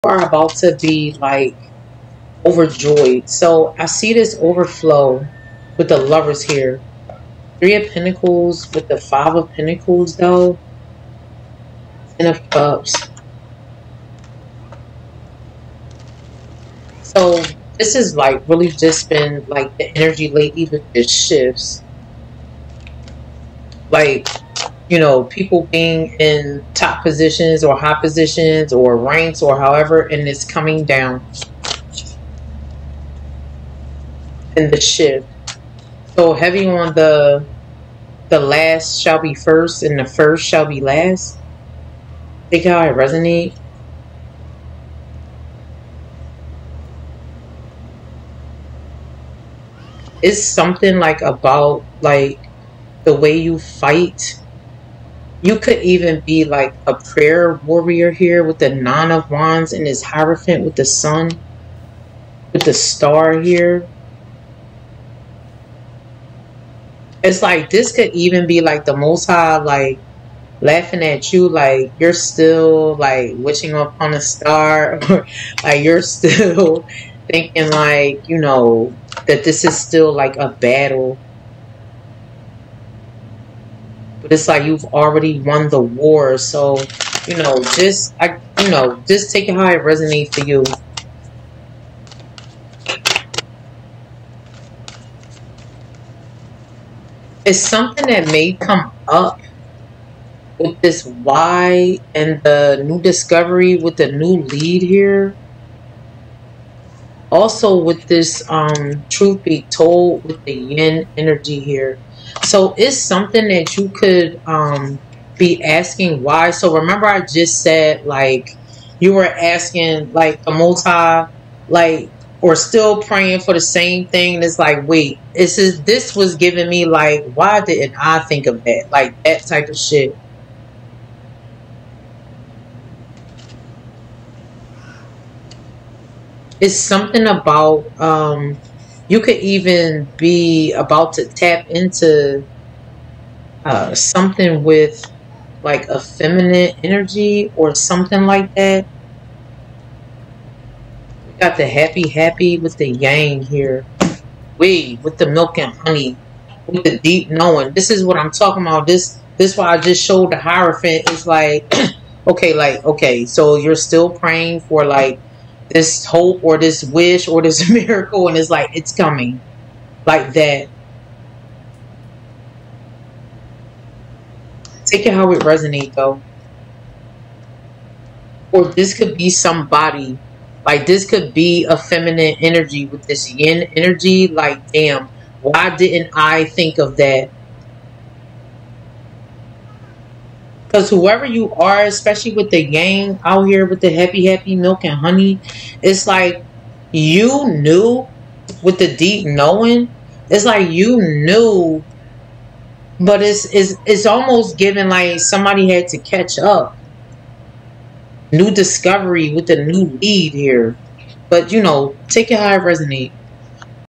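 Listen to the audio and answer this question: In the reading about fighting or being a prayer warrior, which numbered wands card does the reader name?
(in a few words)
Nine of Wands.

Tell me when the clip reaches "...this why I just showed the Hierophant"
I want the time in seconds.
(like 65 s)
159 s.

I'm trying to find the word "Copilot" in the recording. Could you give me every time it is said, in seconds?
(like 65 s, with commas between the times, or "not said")
not said.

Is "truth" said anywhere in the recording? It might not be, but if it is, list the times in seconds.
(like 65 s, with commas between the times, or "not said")
109 s.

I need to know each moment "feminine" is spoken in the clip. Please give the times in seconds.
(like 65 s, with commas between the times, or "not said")
145 s, 181 s.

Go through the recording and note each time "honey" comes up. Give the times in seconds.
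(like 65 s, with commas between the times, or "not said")
155 s, 194 s.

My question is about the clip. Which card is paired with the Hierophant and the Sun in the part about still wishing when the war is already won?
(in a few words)
The Star.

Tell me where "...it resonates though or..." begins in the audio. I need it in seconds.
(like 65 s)
175 s.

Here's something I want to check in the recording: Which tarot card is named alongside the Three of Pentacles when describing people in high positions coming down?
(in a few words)
Five of Pentacles.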